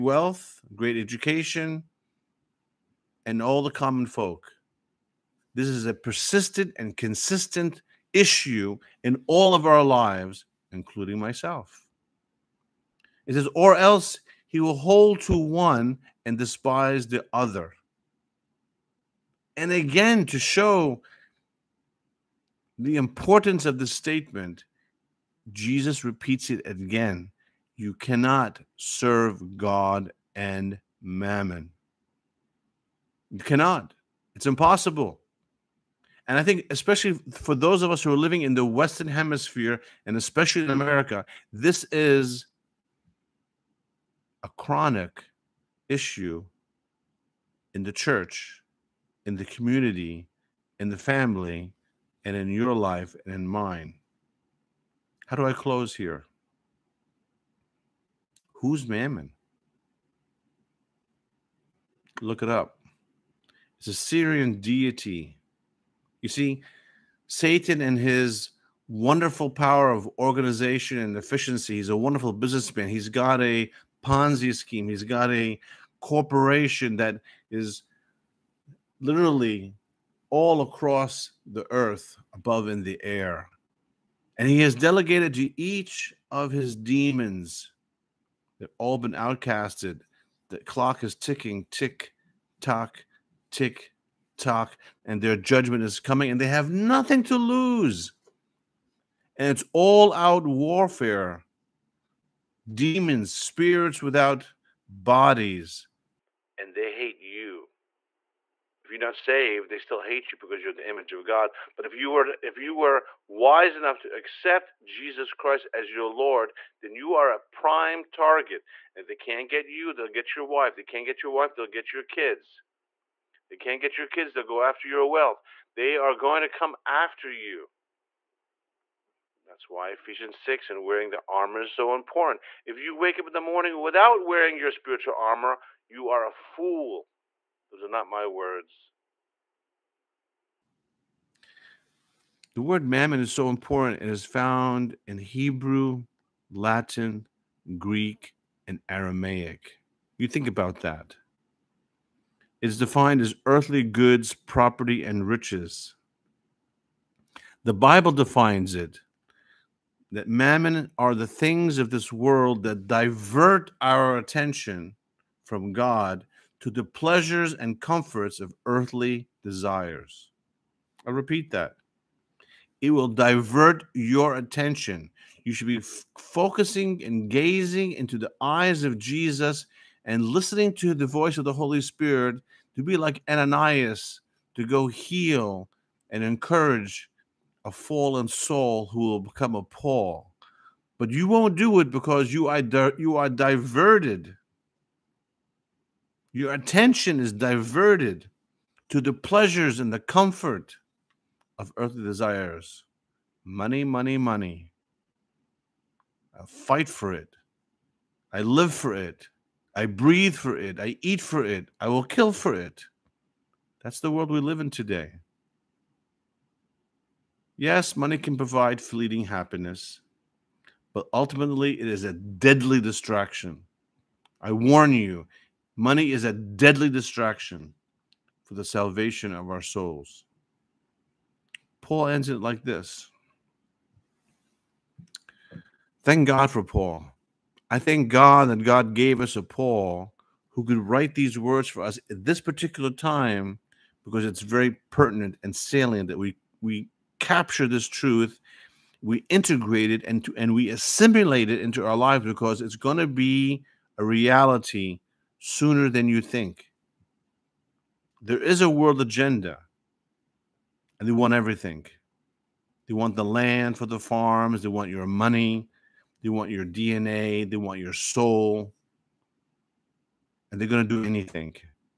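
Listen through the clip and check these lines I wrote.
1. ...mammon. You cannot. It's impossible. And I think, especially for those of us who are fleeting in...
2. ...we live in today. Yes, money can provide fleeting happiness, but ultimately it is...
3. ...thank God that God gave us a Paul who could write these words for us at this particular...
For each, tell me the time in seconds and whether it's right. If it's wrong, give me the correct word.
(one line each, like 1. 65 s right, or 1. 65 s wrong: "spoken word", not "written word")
1. 31 s wrong: "living", not "fleeting"
2. 214 s right
3. 237 s right.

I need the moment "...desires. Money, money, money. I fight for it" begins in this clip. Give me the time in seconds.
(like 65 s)
202 s.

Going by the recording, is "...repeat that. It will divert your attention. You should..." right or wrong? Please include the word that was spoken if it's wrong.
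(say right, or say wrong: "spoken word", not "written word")
right.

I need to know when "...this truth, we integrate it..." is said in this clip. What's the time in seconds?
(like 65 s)
247 s.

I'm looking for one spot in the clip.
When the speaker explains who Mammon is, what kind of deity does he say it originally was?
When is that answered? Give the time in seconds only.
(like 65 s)
63 s.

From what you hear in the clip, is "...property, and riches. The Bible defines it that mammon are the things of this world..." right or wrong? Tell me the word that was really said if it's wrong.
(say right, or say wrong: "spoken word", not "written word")
right.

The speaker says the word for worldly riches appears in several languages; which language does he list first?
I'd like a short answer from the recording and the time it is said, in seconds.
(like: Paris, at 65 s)
Hebrew, at 145 s.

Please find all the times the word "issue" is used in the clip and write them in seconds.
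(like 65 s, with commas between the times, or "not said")
8 s, 45 s.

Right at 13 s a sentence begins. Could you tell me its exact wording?
It says, or else he will hold to one and despise the other.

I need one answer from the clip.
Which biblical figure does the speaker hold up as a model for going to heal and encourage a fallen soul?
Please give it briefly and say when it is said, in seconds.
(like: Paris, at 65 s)
Ananias, at 183 s.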